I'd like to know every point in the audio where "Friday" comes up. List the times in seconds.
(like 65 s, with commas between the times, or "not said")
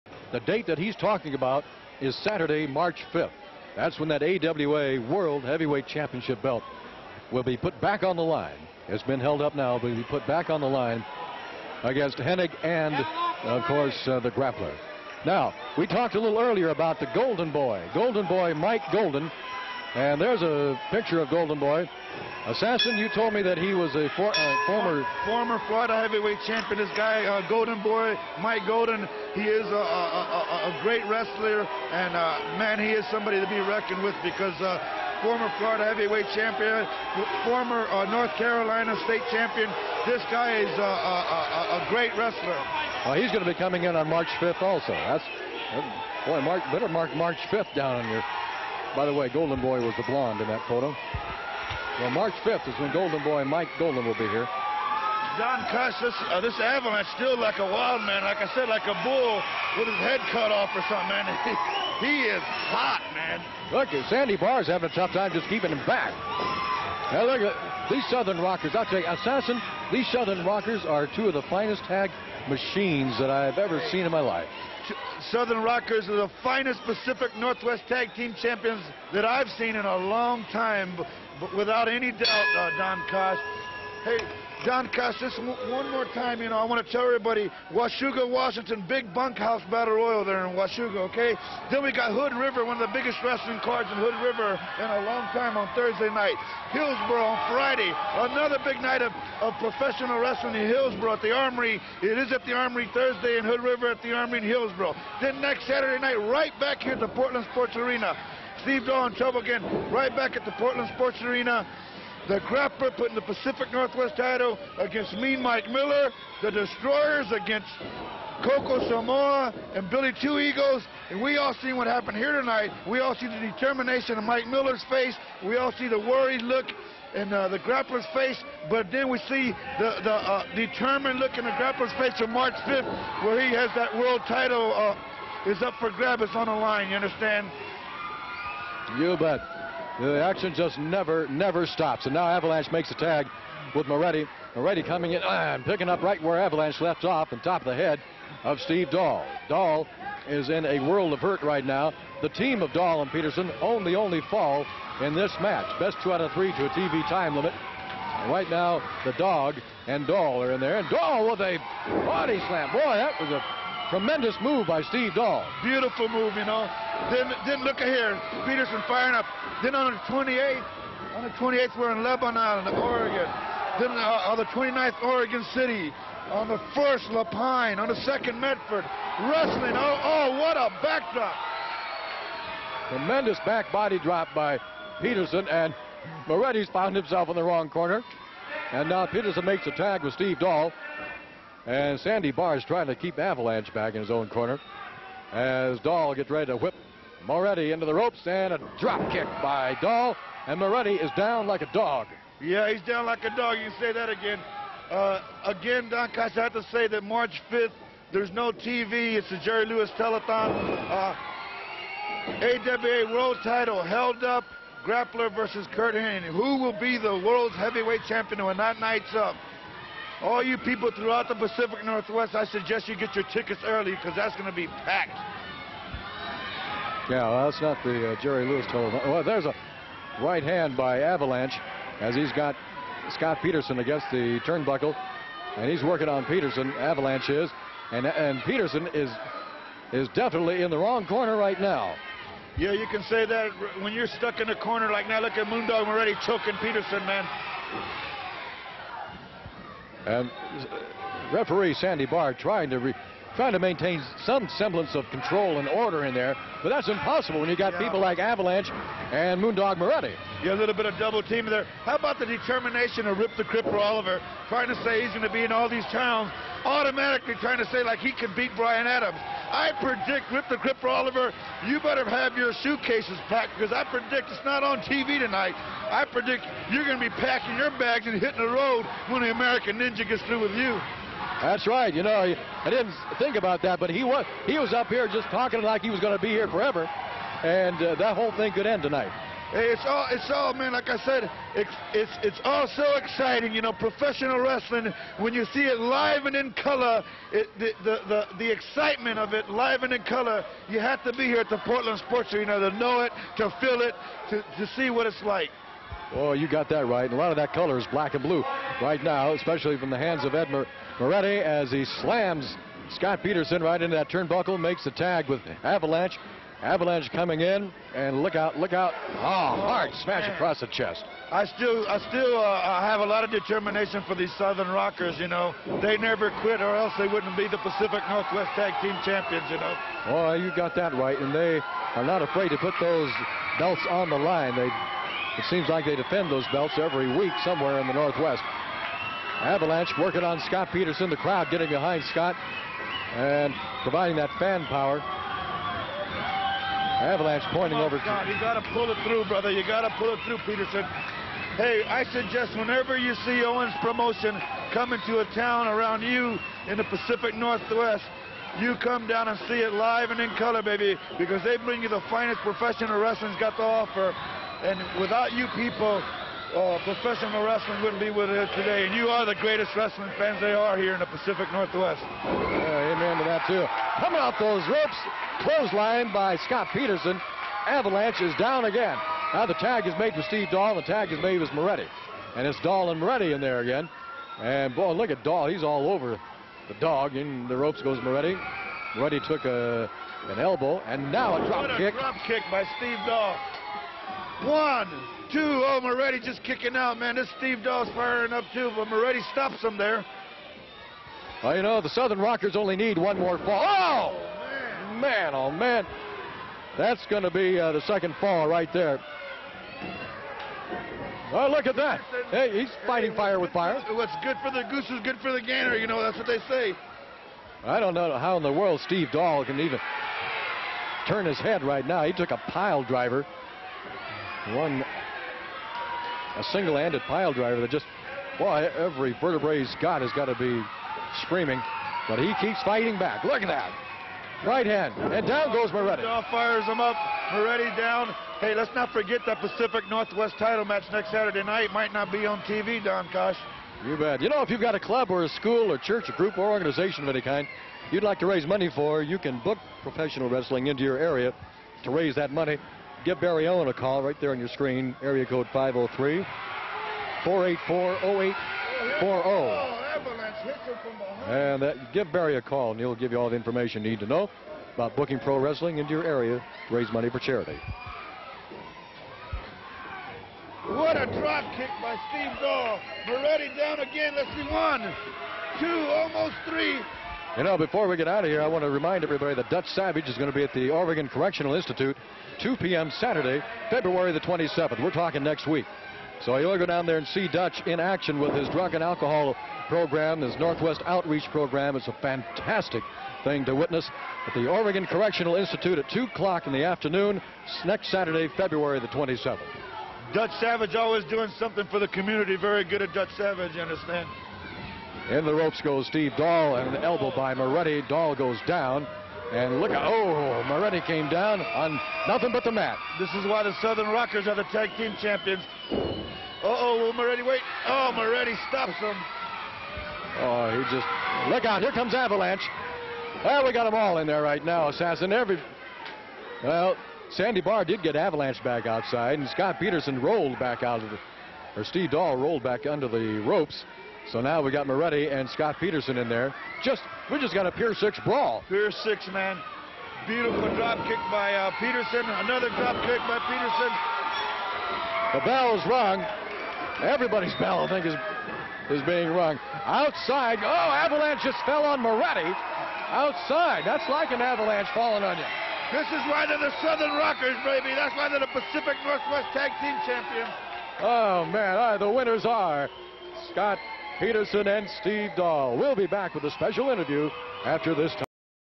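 97 s.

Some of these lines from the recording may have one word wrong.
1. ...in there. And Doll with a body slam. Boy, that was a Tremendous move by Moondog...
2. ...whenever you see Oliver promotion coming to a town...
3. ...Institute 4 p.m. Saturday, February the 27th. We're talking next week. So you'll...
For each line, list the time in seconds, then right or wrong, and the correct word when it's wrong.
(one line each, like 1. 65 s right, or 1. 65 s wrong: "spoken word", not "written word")
1. 160 s wrong: "Steve", not "Moondog"
2. 352 s wrong: "Owens", not "Oliver"
3. 481 s wrong: "2", not "4".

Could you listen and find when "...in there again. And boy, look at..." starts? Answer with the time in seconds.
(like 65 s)
383 s.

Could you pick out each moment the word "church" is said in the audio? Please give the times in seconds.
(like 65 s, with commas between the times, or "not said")
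445 s.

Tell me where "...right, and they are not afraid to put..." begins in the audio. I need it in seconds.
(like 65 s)
330 s.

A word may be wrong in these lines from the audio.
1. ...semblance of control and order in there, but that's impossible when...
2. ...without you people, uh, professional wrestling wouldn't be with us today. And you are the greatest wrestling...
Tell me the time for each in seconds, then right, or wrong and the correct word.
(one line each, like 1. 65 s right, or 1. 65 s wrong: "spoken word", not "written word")
1. 254 s right
2. 365 s right.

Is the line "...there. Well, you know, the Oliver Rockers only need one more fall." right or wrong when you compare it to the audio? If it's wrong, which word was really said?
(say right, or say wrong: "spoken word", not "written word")
wrong: "Southern", not "Oliver".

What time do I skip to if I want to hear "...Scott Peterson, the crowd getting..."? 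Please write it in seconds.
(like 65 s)
340 s.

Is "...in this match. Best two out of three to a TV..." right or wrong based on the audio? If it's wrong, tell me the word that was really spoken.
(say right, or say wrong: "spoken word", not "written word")
right.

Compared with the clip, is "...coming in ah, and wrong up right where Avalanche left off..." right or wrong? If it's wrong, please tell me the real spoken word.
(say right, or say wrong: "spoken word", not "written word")
wrong: "picking", not "wrong".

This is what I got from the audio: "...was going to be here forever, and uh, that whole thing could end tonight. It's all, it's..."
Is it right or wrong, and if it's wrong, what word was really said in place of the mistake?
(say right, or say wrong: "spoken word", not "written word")
right.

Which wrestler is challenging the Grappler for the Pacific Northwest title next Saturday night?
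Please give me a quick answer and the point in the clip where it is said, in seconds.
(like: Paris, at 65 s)
Mean Mike Miller, at 115 s.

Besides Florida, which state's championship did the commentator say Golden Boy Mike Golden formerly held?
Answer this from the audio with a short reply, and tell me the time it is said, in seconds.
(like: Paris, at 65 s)
North Carolina, at 38 s.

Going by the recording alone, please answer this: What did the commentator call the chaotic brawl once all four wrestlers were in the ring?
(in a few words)
Pier six brawl.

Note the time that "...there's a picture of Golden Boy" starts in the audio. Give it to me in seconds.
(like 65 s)
20 s.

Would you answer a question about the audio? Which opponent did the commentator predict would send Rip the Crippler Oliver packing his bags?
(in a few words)
The American Ninja.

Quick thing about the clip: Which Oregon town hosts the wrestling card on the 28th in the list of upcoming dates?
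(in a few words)
Lebanon.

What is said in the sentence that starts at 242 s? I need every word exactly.
Yeah, you can say that when you're stuck in a corner like now.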